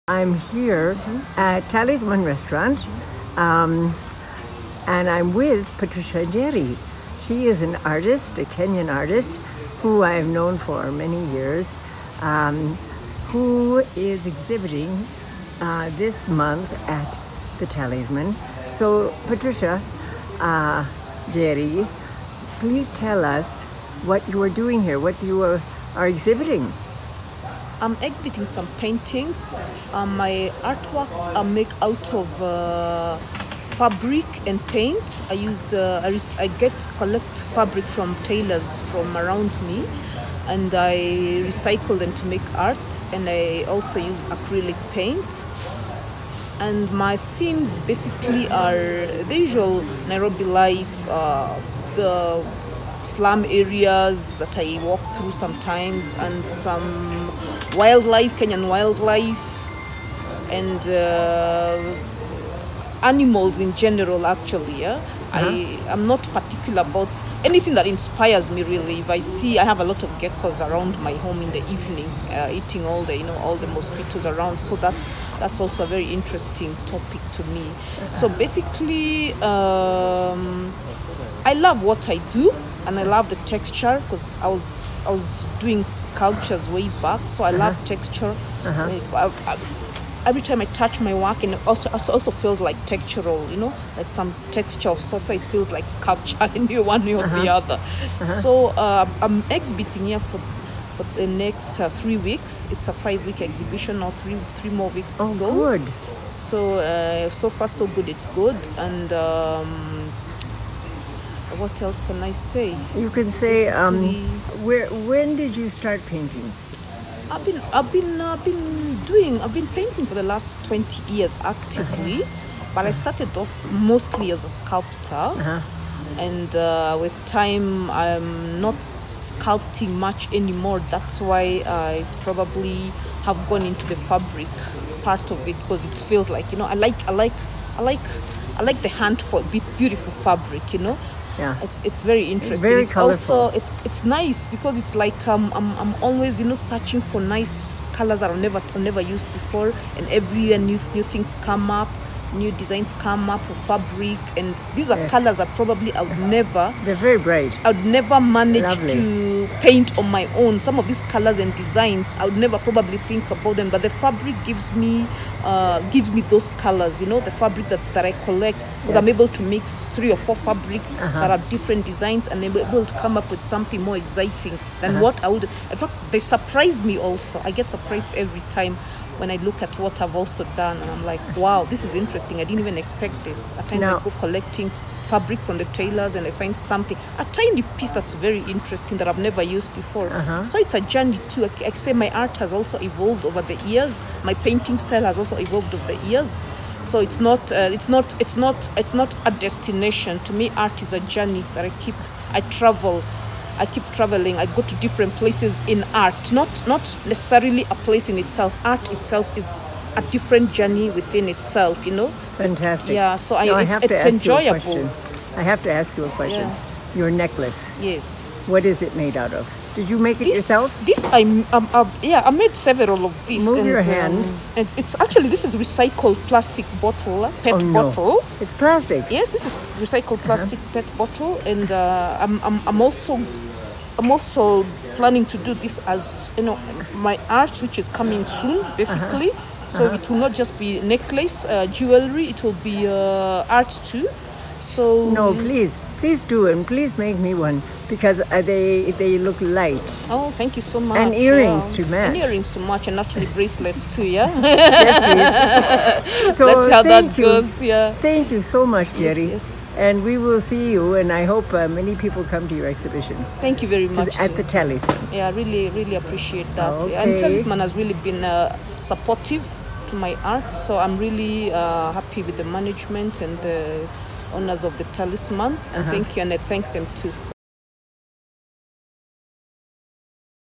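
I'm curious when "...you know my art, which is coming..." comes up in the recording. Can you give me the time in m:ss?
3:56.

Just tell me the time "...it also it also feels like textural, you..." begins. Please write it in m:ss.
1:31.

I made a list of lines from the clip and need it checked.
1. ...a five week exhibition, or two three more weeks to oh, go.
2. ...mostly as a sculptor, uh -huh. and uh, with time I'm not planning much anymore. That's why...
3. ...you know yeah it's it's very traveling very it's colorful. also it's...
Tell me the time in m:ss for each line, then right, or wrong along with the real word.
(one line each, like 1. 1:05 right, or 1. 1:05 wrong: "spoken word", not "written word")
1. 1:42 wrong: "three", not "two"
2. 2:03 wrong: "sculpting", not "planning"
3. 2:20 wrong: "interesting", not "traveling".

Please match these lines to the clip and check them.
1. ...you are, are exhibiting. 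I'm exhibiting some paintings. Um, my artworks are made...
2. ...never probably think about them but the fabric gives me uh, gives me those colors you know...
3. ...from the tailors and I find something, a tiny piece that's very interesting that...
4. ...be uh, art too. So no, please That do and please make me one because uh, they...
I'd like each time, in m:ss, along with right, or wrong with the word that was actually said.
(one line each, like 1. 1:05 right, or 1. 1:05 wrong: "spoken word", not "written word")
1. 0:25 right
2. 2:42 right
3. 3:05 right
4. 4:02 wrong: "Please", not "That".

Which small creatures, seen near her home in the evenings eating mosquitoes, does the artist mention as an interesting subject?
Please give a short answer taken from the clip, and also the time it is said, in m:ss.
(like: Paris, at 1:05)
Geckos, at 1:10.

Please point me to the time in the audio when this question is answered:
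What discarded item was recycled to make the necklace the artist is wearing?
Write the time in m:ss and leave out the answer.
3:46.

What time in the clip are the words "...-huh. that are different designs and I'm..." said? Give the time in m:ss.
2:50.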